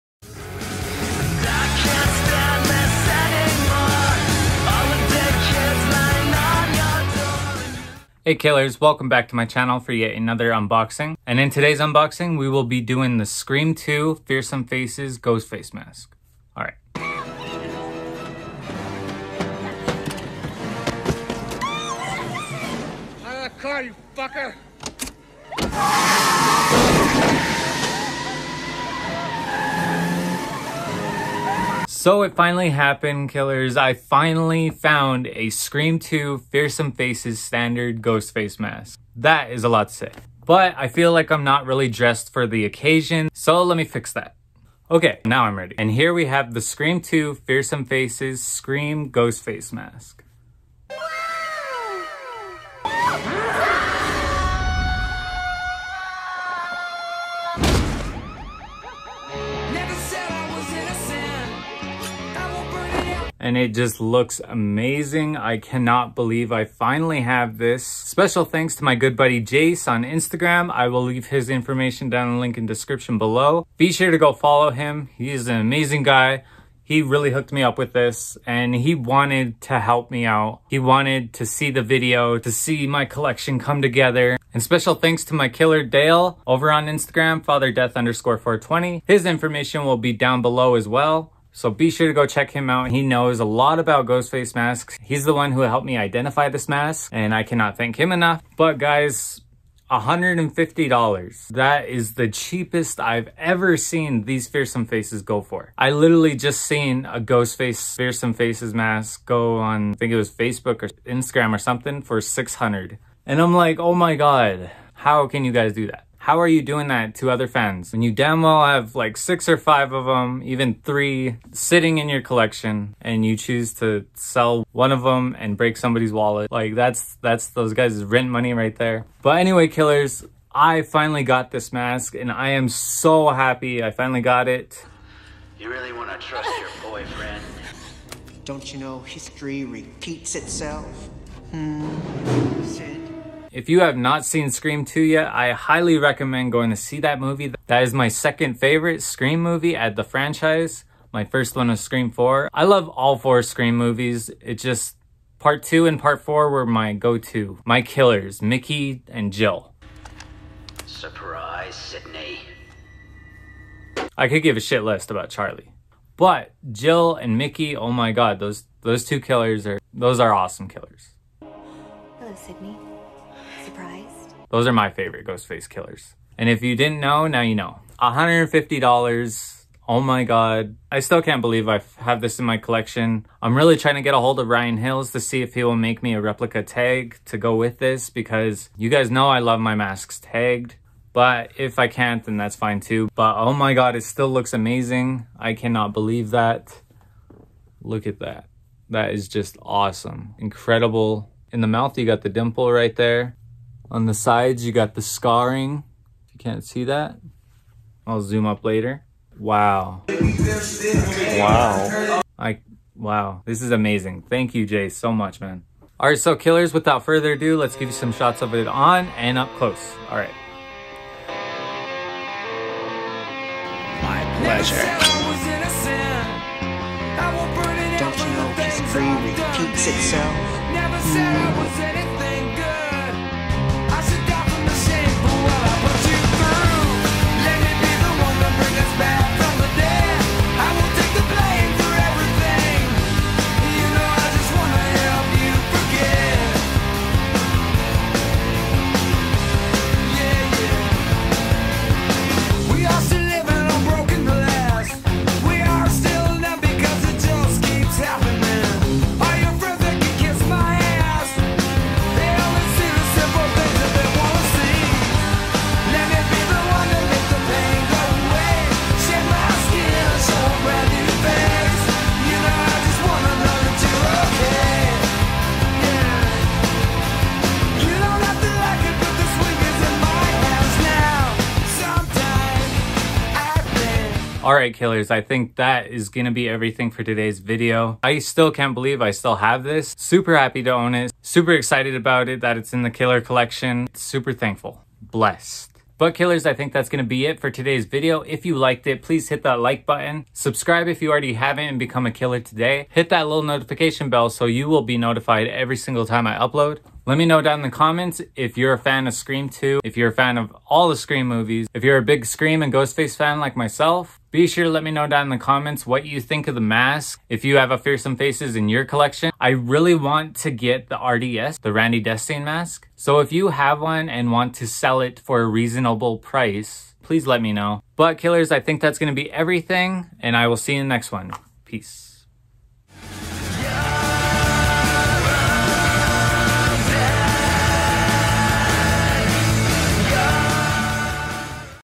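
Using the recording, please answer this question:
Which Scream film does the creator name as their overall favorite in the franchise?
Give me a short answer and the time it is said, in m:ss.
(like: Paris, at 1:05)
Scream 4, at 2:31.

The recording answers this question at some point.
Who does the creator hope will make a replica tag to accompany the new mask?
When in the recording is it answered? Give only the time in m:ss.
3:04.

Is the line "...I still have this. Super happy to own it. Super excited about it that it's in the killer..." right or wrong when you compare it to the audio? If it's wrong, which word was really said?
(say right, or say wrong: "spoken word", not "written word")
right.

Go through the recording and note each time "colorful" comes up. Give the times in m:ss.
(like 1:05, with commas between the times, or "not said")
not said.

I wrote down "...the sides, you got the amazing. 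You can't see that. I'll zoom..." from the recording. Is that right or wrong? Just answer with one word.
wrong.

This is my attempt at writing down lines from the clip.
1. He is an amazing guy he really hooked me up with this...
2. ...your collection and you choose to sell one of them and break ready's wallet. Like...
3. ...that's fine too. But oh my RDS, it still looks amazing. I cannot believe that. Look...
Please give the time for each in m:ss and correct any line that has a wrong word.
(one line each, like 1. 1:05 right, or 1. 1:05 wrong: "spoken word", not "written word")
1. 1:15 right
2. 2:02 wrong: "somebody", not "ready"
3. 3:12 wrong: "God", not "RDS".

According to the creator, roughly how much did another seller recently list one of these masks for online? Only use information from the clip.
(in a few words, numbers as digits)
600.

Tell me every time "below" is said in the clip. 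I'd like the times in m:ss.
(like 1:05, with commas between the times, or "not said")
1:13, 1:30.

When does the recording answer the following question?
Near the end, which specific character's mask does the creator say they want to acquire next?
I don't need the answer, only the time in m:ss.
5:21.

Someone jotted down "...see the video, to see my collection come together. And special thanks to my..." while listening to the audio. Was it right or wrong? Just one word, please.
right.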